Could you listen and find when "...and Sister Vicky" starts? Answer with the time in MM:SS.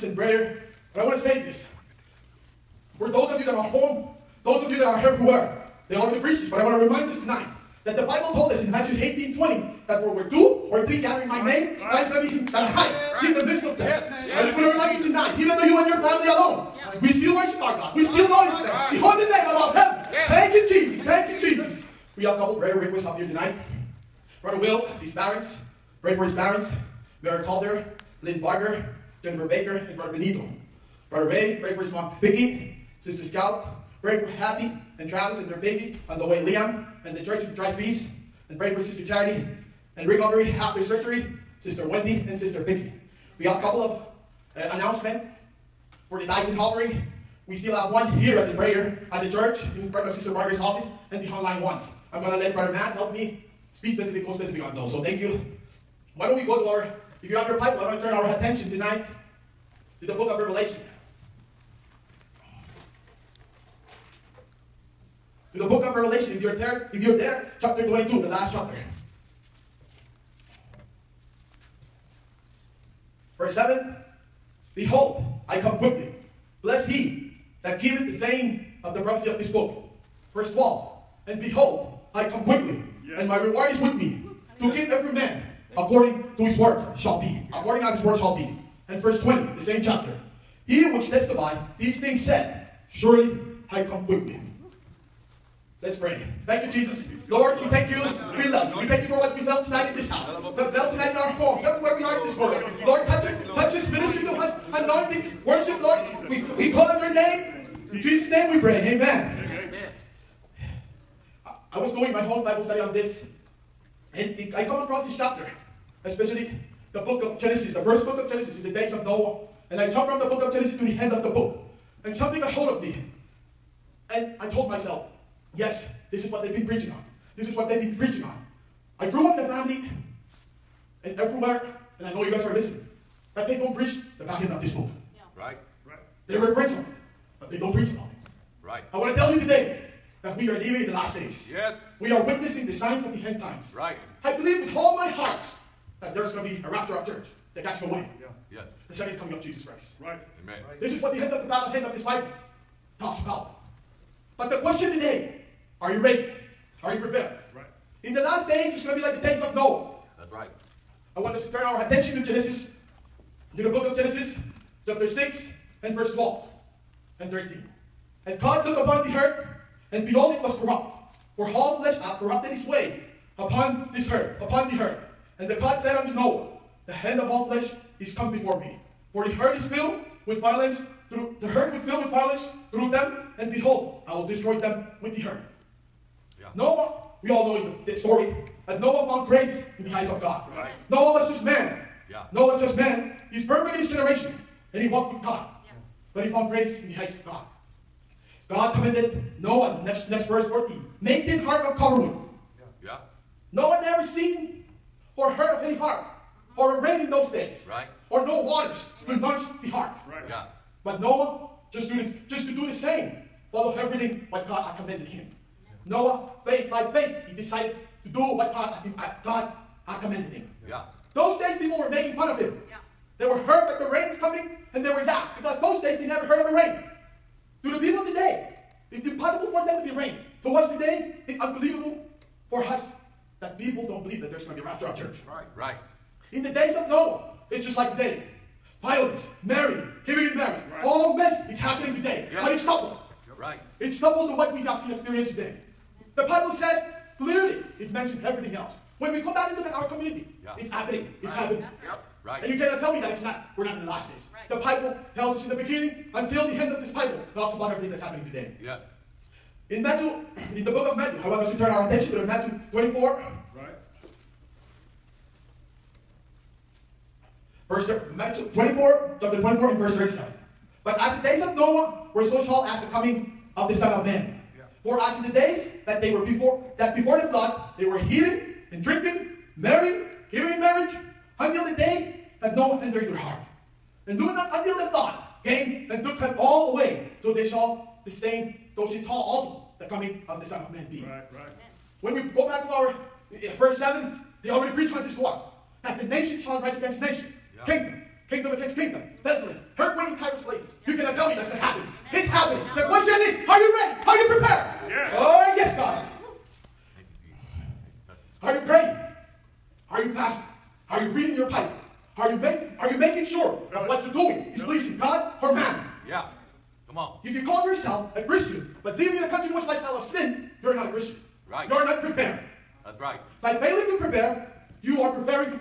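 00:42.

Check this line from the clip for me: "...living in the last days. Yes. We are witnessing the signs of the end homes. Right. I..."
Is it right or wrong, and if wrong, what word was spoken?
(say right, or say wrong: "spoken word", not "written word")
wrong: "times", not "homes".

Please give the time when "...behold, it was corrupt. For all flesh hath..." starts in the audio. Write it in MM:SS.
02:50.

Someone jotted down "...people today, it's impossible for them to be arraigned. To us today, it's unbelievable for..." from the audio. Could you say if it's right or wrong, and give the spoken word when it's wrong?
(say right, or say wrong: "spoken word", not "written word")
right.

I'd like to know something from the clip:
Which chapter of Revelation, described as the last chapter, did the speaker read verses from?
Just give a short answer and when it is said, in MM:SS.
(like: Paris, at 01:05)
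Chapter 22, at 01:07.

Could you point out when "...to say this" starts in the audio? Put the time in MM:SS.
00:01.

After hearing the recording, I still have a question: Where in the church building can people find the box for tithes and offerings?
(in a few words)
In front of Sister Margaret's office.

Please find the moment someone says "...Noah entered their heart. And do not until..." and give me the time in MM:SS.
04:42.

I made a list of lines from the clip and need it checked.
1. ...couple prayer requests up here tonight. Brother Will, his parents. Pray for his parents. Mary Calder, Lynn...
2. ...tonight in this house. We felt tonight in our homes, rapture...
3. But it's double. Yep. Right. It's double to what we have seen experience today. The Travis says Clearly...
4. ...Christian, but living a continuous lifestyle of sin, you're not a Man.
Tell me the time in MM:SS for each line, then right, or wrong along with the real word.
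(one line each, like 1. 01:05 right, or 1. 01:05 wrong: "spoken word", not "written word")
1. 00:22 right
2. 01:39 wrong: "everywhere", not "rapture"
3. 04:02 wrong: "Bible", not "Travis"
4. 05:18 wrong: "Christian", not "Man".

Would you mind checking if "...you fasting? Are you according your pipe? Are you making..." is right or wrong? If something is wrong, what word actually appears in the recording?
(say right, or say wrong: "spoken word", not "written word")
wrong: "reading", not "according".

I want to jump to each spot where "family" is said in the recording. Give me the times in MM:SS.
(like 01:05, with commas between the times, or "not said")
00:15, 02:09.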